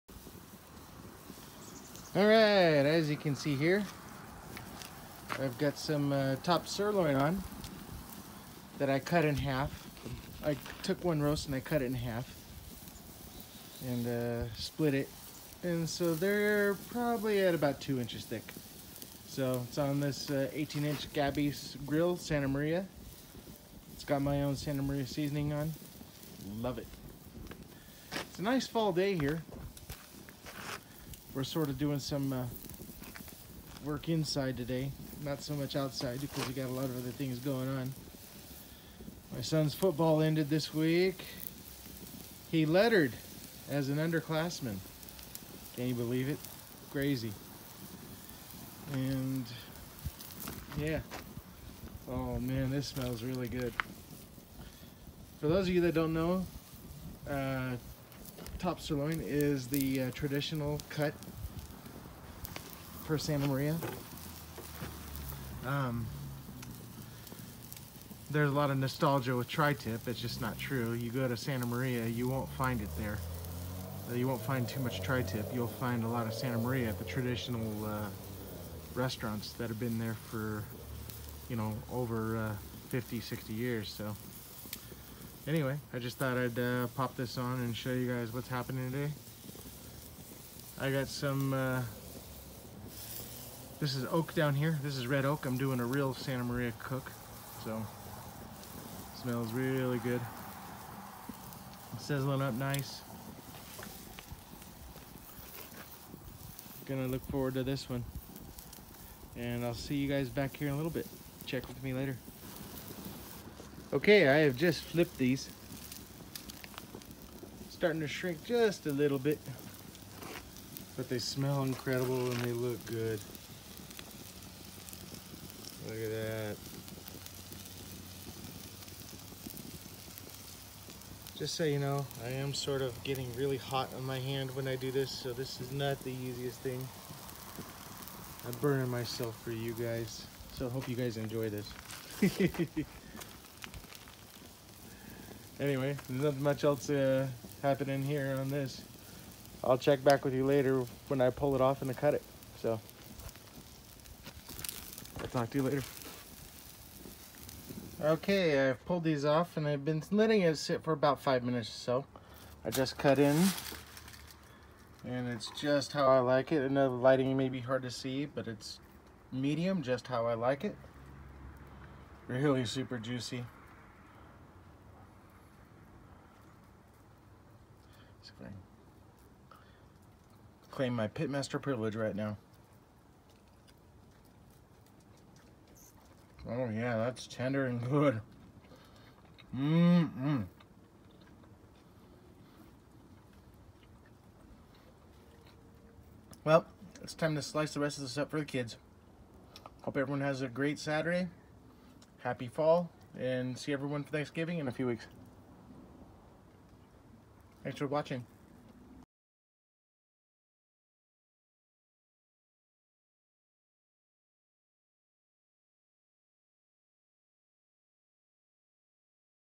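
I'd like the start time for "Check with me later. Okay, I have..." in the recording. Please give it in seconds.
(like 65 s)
111 s.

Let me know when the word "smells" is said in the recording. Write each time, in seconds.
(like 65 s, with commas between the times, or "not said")
52 s, 99 s, 121 s.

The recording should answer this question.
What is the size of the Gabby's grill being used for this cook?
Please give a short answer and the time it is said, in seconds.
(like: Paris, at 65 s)
18-inch, at 20 s.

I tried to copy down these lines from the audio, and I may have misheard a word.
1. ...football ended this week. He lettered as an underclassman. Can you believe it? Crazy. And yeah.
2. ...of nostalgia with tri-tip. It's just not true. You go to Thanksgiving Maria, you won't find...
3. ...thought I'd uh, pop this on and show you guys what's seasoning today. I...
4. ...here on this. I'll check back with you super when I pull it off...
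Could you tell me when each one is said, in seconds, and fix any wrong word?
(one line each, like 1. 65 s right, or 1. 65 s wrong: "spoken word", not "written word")
1. 39 s right
2. 68 s wrong: "Santa", not "Thanksgiving"
3. 86 s wrong: "happening", not "seasoning"
4. 148 s wrong: "later", not "super".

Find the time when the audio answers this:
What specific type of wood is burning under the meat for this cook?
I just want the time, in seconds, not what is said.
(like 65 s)
95 s.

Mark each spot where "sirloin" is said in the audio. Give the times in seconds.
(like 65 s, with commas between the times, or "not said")
6 s, 58 s.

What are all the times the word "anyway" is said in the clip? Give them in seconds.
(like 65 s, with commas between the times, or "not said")
85 s, 145 s.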